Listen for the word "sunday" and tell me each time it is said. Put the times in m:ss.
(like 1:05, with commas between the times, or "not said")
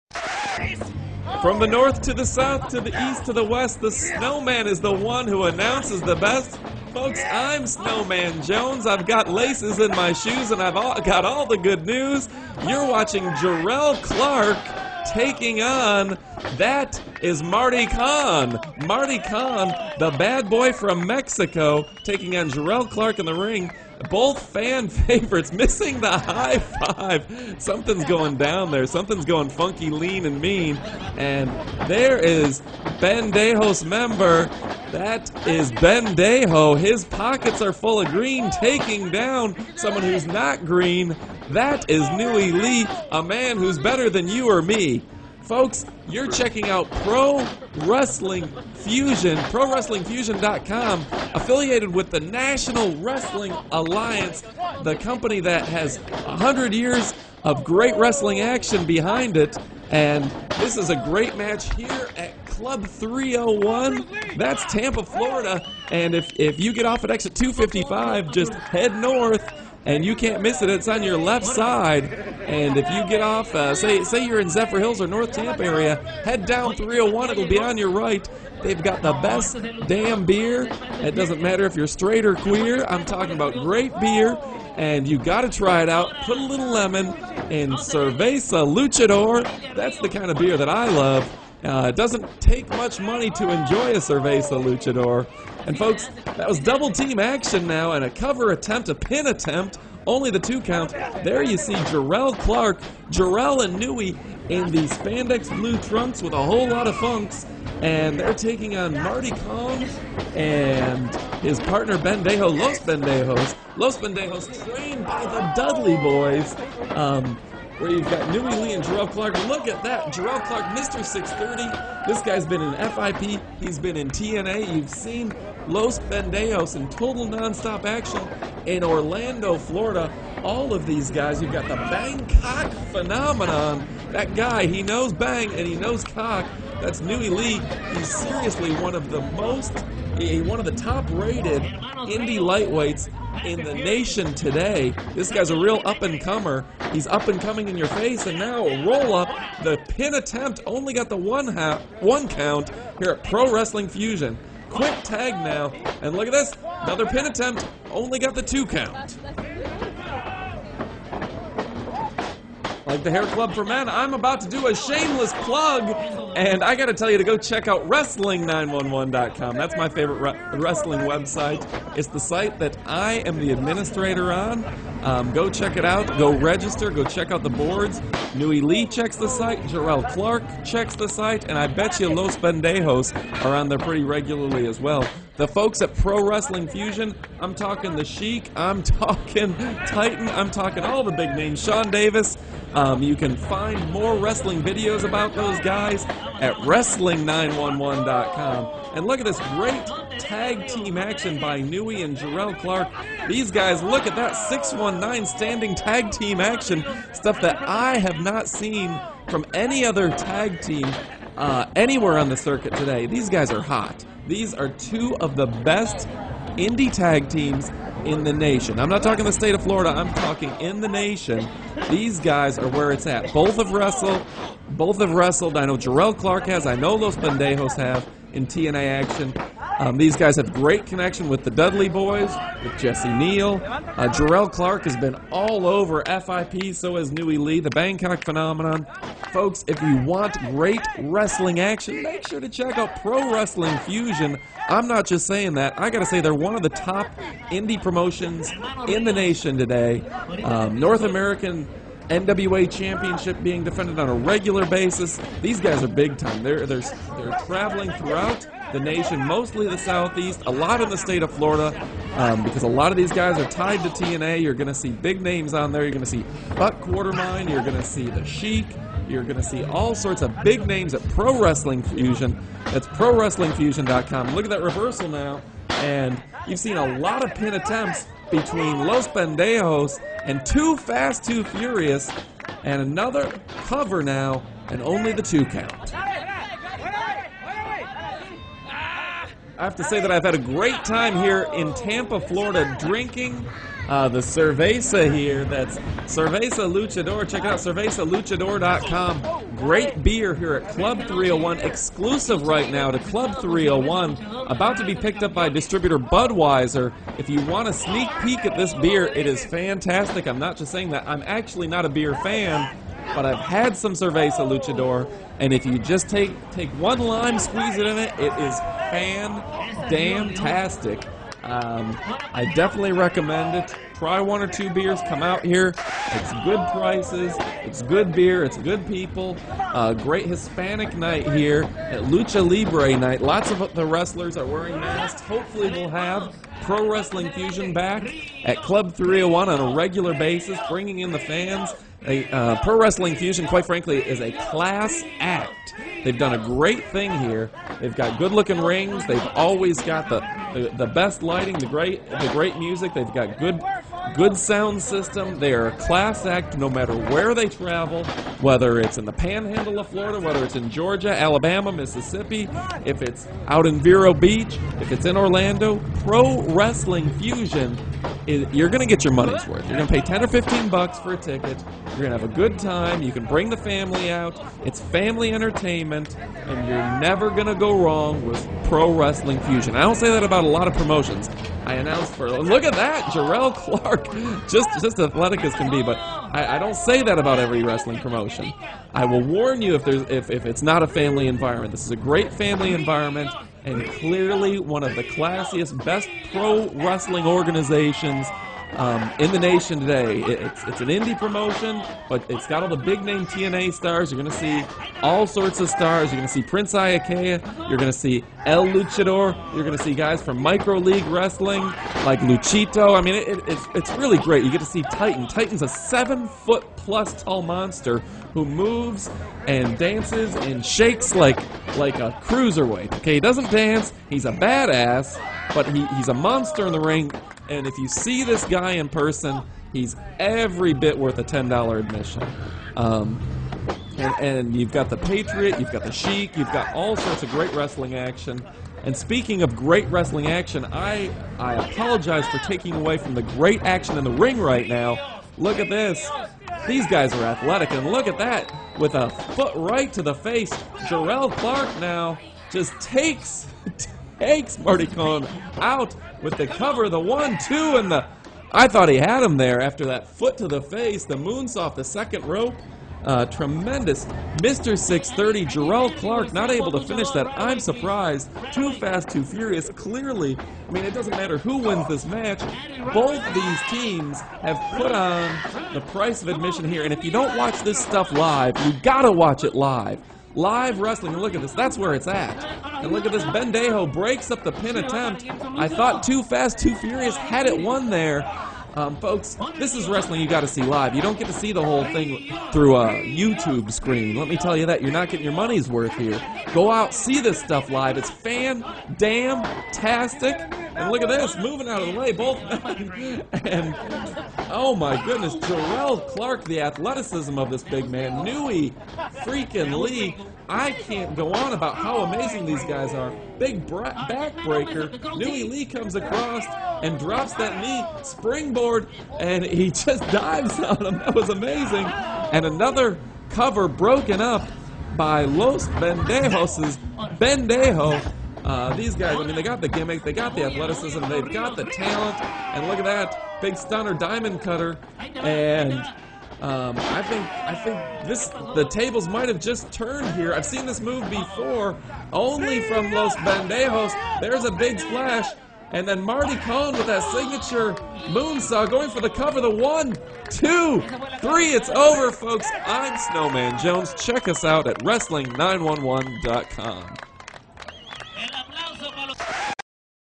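not said.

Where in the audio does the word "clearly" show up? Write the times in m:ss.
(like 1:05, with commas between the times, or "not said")
6:33, 7:49.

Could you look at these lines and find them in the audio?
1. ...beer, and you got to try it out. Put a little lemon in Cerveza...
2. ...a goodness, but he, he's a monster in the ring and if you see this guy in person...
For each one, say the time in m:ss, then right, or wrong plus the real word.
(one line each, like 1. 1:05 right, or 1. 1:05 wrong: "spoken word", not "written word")
1. 1:23 right
2. 7:04 wrong: "badass", not "goodness".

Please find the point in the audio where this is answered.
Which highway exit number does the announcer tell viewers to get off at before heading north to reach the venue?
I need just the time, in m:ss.
1:07.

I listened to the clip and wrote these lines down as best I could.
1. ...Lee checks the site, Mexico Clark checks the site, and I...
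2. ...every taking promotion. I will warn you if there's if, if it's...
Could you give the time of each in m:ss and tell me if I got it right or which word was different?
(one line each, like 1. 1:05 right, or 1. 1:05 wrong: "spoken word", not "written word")
1. 2:58 wrong: "Jerrelle", not "Mexico"
2. 6:27 wrong: "wrestling", not "taking".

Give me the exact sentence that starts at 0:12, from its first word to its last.
You're watching Jerrelle Clark taking on that is Marty Con.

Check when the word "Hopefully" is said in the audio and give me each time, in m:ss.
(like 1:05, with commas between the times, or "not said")
5:35.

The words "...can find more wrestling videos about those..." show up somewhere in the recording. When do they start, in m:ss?
3:13.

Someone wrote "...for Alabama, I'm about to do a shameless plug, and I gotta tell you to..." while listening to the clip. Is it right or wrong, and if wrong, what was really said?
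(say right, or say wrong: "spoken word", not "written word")
wrong: "Men", not "Alabama".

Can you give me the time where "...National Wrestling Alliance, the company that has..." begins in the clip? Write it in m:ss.
0:52.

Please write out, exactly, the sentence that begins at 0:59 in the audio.
And this is a great match here at Club 301.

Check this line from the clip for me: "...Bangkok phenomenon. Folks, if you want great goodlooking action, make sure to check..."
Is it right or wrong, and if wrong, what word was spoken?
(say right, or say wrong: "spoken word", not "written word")
wrong: "wrestling", not "goodlooking".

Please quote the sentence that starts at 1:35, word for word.
And folks, that was double team action now and a cover attempt, a pin attempt, only the two count.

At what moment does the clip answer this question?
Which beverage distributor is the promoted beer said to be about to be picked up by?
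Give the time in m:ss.
5:05.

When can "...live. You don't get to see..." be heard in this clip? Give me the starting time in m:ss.
8:10.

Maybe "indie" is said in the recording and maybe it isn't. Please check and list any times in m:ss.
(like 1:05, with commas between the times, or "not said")
2:21, 3:36, 4:07, 6:40.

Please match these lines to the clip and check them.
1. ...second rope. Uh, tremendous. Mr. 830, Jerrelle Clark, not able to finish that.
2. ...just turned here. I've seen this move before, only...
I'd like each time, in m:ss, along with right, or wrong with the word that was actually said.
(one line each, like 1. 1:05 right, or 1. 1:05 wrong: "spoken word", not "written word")
1. 7:41 wrong: "630", not "830"
2. 8:59 right.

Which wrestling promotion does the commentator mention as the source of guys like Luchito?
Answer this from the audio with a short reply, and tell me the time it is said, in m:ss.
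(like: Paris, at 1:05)
Micro League Wrestling, at 6:50.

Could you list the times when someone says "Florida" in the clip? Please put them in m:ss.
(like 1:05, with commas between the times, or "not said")
1:05, 2:09, 3:39, 4:21, 4:52, 5:59.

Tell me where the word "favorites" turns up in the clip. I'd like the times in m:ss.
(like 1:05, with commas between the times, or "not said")
0:24, 2:49.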